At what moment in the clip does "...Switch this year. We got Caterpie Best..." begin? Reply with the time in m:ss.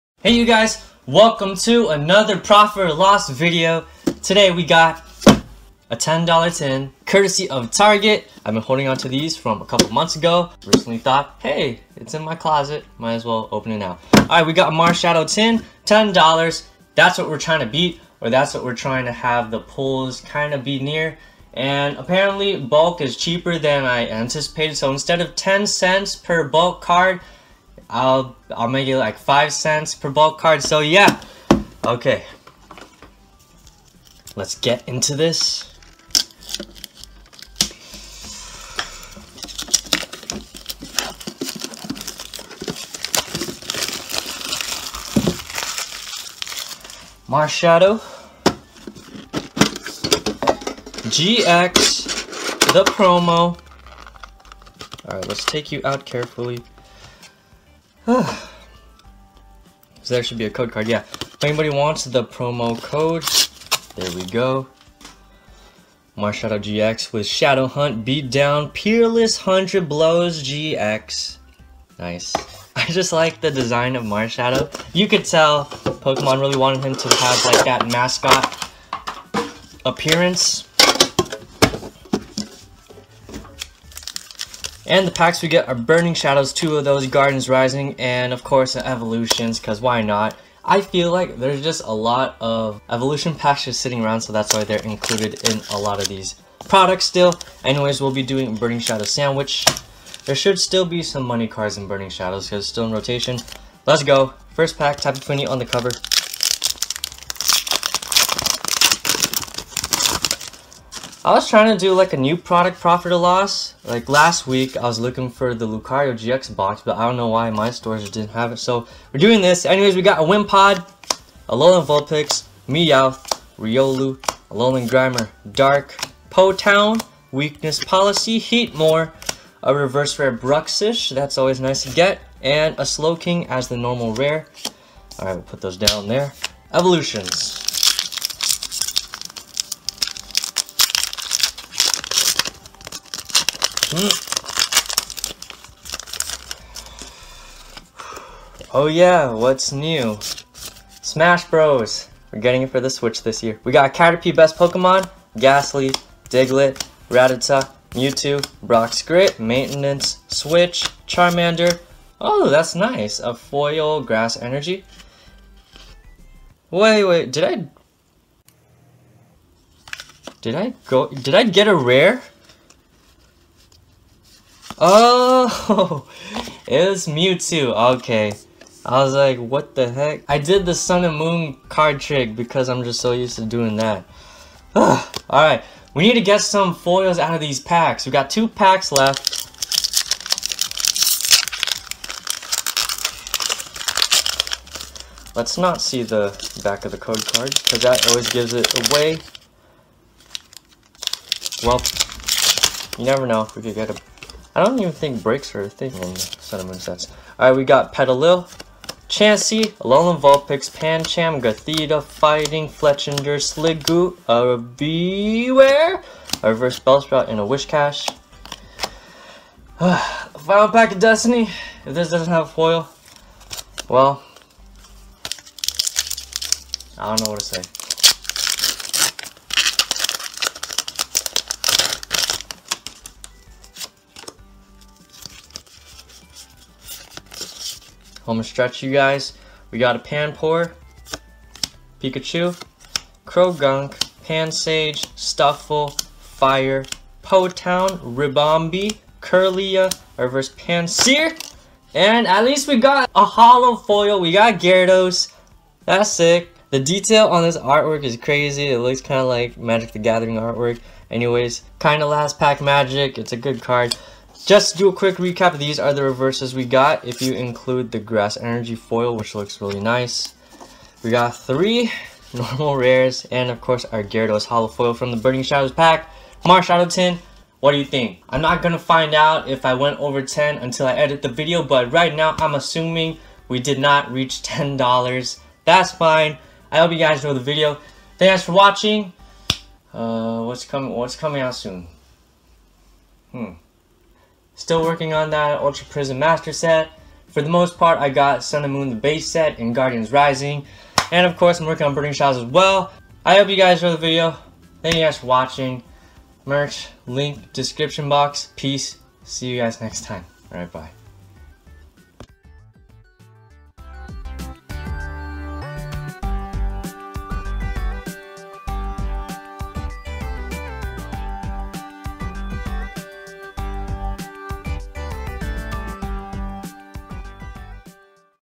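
2:32.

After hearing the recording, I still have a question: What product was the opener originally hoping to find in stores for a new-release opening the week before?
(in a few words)
Lucario GX box.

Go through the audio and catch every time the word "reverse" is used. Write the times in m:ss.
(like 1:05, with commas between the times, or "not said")
2:09, 3:36, 4:10, 4:26.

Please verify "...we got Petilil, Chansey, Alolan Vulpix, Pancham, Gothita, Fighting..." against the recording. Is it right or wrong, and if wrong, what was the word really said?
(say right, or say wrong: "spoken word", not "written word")
right.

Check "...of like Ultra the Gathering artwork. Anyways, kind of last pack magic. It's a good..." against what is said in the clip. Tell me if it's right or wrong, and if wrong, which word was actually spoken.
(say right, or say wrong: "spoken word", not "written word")
wrong: "Magic", not "Ultra".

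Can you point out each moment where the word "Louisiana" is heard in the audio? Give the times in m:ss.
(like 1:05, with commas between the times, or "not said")
not said.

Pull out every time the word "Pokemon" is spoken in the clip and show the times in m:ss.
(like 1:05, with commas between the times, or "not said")
1:15, 2:34.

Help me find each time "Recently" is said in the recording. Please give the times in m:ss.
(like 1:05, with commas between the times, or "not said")
0:10.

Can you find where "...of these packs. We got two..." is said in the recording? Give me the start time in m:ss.
3:07.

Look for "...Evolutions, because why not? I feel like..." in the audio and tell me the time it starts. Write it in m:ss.
1:28.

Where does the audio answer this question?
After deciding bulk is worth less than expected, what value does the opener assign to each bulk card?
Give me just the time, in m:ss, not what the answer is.
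0:29.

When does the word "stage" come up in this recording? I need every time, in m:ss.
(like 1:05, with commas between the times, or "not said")
not said.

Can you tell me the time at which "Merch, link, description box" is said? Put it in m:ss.
5:06.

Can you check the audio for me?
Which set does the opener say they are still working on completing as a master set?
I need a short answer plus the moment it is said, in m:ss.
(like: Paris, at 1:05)
Ultra Prism, at 4:55.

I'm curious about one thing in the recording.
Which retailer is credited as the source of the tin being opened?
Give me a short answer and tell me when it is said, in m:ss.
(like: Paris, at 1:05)
Target, at 0:07.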